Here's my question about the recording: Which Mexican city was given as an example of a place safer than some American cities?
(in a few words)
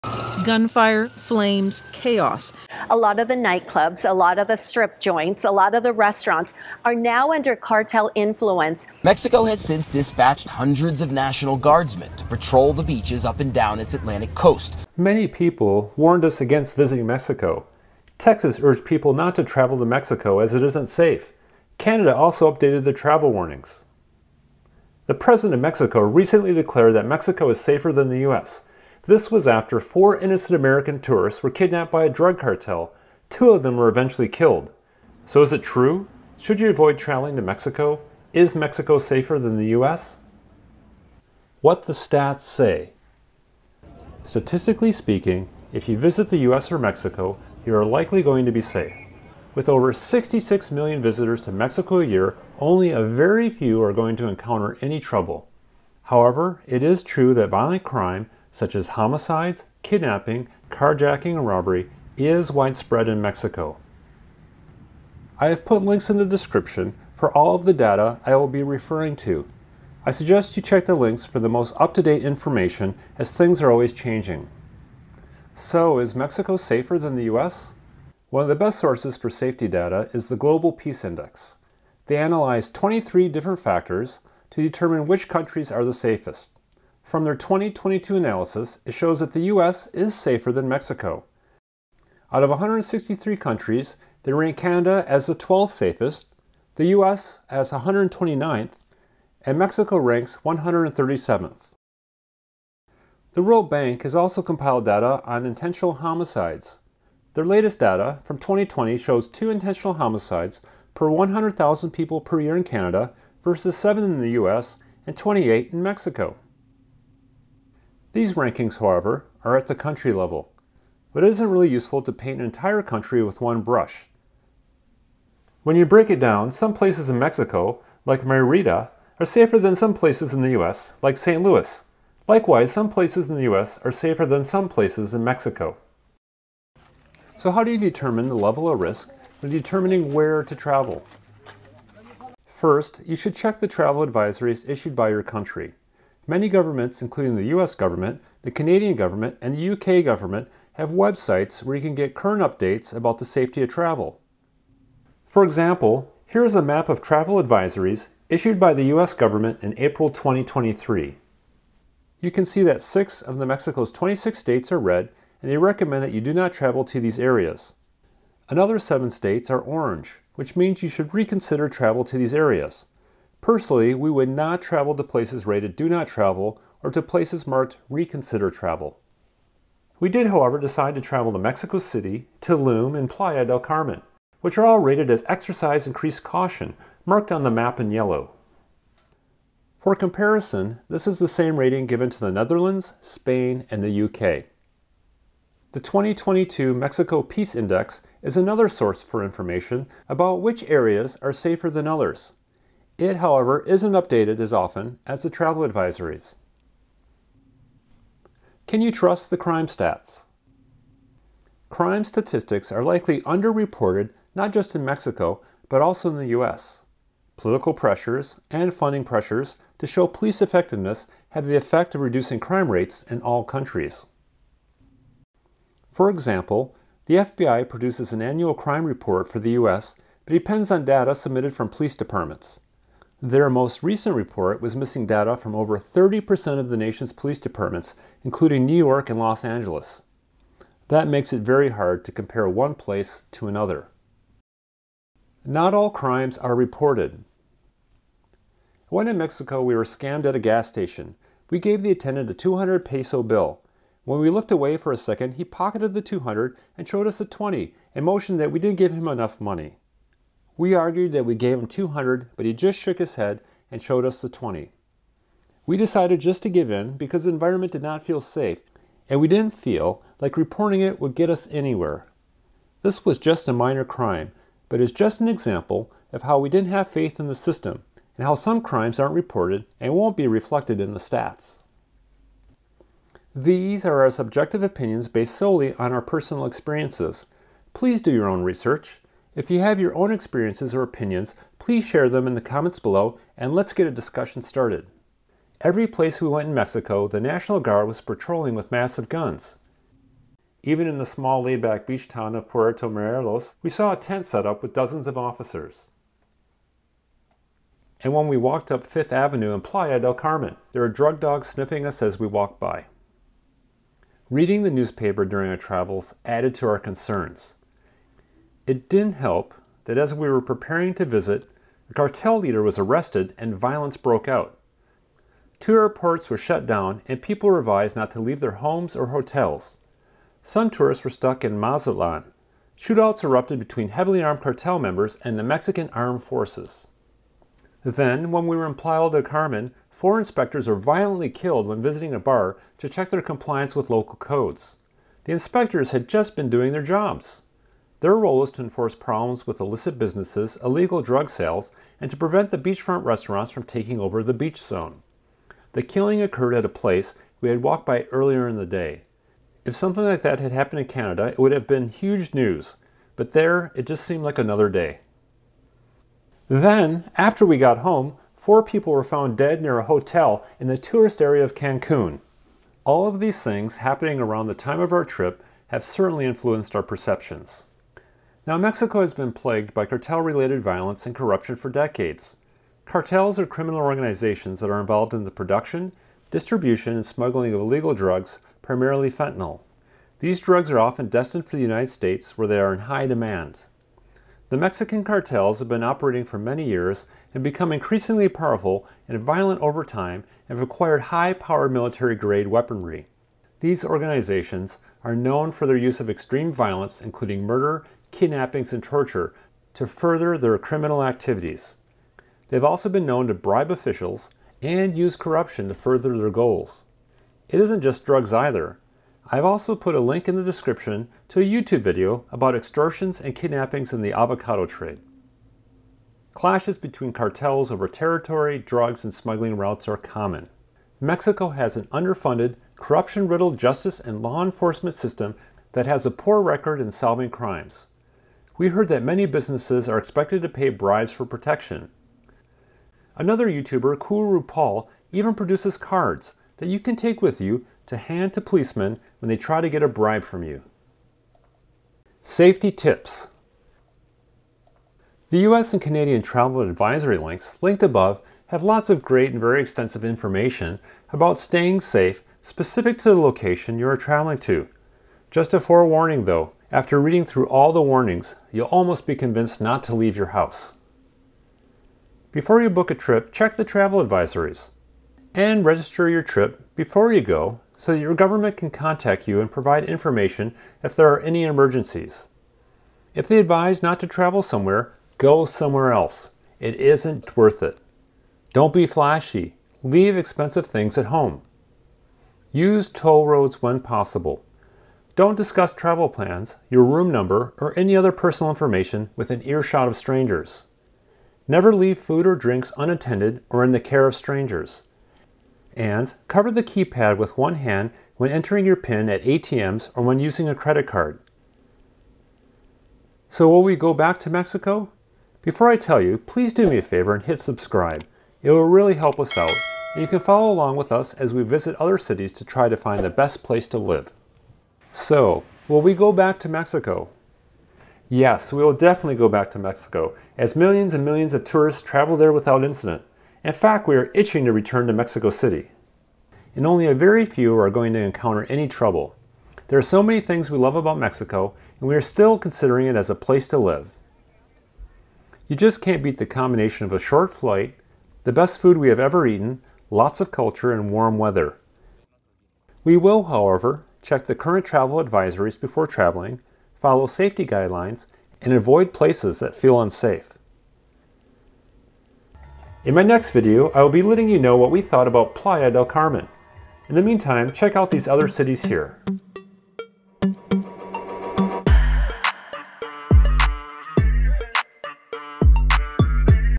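Merida.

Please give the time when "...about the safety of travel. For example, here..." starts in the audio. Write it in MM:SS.
02:32.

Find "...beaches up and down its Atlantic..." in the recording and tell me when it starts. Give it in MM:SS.
00:12.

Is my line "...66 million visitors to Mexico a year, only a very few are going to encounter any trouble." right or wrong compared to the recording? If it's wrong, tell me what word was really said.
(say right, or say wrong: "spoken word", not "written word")
right.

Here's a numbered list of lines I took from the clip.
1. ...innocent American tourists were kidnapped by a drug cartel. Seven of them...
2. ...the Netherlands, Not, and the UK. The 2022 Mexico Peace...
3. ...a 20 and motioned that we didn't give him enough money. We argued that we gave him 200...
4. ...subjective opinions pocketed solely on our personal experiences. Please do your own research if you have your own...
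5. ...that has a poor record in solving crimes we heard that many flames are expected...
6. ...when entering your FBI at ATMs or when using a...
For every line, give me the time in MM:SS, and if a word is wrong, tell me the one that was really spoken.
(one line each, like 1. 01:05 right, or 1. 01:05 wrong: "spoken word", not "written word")
1. 00:30 wrong: "Two", not "Seven"
2. 03:12 wrong: "Spain", not "Not"
3. 04:17 right
4. 04:44 wrong: "based", not "pocketed"
5. 07:15 wrong: "businesses", not "flames"
6. 08:28 wrong: "PIN", not "FBI".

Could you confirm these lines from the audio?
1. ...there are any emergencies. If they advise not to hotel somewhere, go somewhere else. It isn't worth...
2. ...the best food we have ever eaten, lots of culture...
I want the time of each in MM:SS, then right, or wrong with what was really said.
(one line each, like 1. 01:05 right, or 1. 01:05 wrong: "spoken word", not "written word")
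1. 08:00 wrong: "travel", not "hotel"
2. 09:08 right.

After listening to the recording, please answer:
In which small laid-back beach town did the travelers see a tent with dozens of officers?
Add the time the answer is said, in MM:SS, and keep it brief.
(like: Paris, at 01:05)
Puerto Morelos, at 05:02.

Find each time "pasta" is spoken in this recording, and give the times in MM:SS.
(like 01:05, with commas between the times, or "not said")
not said.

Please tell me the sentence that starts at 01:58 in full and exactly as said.
These rankings, however, are at the country level, but it isn't really useful to paint an entire country with one brush.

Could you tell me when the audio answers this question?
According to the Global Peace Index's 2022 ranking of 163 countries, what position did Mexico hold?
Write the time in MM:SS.
01:40.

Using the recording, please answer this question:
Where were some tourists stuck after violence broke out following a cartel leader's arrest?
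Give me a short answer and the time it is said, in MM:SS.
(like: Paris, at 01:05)
Mazatlan, at 05:31.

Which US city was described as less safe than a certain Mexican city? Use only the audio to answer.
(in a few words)
St. Louis.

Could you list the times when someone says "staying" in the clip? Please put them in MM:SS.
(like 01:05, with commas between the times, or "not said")
07:41.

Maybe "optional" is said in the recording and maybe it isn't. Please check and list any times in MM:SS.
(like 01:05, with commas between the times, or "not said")
not said.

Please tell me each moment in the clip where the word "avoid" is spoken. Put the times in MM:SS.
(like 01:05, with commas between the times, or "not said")
00:36, 09:18.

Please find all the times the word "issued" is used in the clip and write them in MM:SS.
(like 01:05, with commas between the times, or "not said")
02:24, 02:38.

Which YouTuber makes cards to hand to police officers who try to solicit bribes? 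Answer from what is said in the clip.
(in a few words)
Kuru Paul.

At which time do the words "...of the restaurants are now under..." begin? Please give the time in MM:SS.
00:05.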